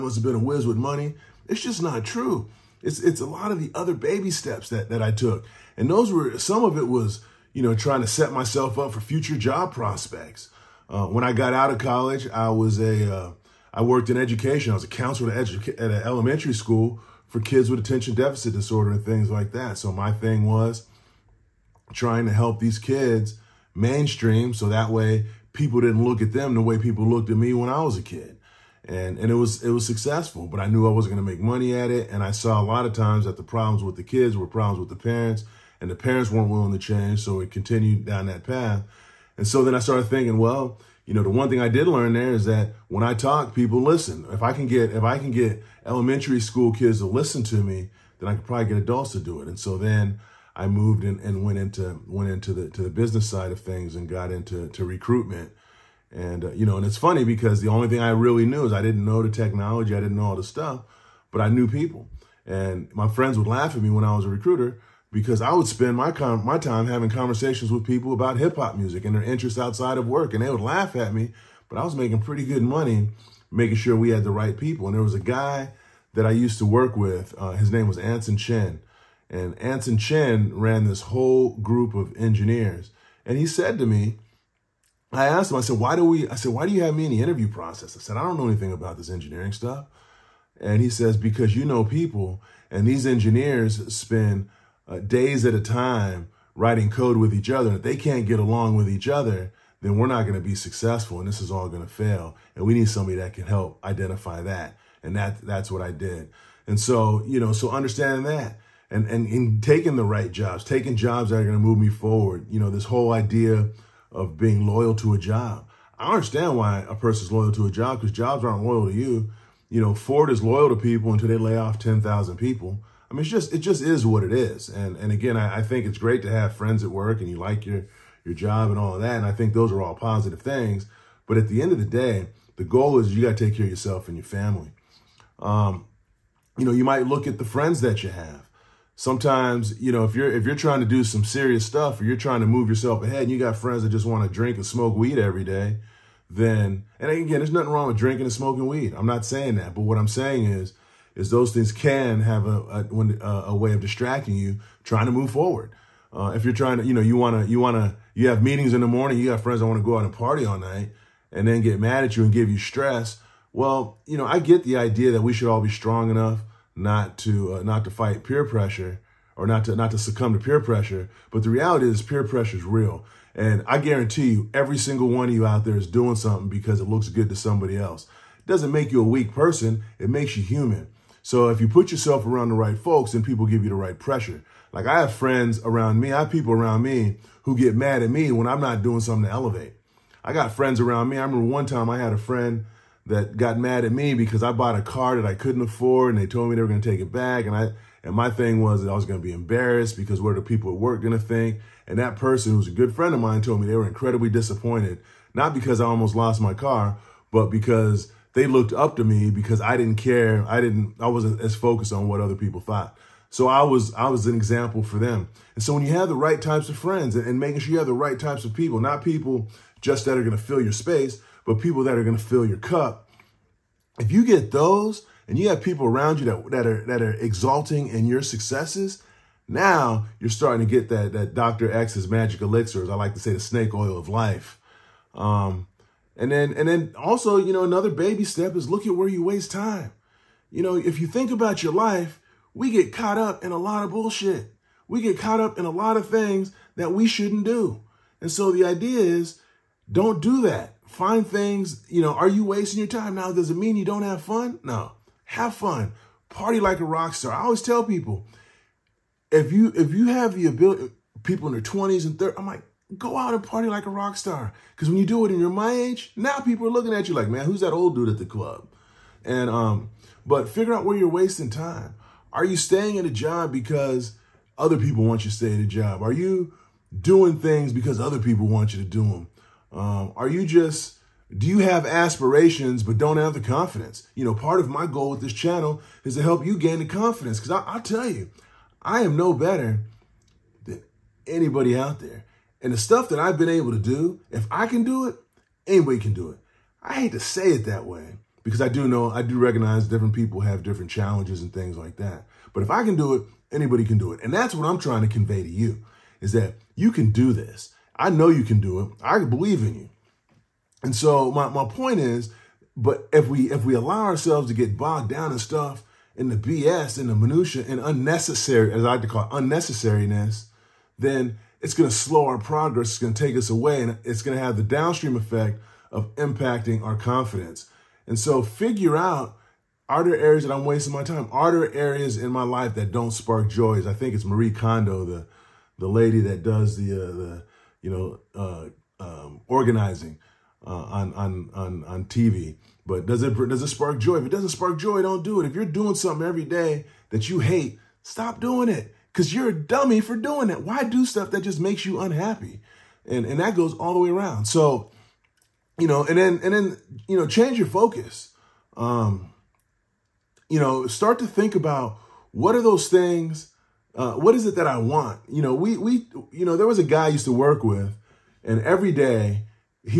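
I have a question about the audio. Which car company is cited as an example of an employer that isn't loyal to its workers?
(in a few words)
Ford.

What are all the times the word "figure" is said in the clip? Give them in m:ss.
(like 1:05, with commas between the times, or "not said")
4:30, 5:28.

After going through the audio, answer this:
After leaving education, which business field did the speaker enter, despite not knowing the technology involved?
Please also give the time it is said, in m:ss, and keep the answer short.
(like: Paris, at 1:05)
Recruitment, at 0:54.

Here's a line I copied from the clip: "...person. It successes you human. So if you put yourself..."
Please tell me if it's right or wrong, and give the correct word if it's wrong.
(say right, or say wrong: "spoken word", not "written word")
wrong: "makes", not "successes".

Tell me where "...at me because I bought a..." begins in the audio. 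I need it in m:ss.
3:13.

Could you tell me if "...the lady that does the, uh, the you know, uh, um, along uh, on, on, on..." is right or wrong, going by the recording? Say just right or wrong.
wrong.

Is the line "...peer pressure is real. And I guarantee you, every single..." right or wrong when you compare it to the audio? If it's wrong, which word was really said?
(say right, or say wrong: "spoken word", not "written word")
right.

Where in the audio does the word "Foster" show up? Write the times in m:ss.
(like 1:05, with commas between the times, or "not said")
not said.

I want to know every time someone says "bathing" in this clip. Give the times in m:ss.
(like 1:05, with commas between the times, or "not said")
not said.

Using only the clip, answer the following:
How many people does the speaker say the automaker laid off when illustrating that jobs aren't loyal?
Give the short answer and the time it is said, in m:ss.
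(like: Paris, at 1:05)
10,000, at 2:01.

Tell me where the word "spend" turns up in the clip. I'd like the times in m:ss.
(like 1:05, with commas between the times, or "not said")
1:05, 1:33.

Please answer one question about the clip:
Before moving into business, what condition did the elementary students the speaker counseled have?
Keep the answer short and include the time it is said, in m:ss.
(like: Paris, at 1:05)
attention deficit disorder, at 0:17.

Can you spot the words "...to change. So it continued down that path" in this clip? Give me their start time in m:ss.
0:36.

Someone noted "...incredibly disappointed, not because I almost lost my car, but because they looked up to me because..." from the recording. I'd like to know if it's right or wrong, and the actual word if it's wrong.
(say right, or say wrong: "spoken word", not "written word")
right.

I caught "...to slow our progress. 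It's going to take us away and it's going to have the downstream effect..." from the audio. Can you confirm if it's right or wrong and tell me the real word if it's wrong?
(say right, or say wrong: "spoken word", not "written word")
right.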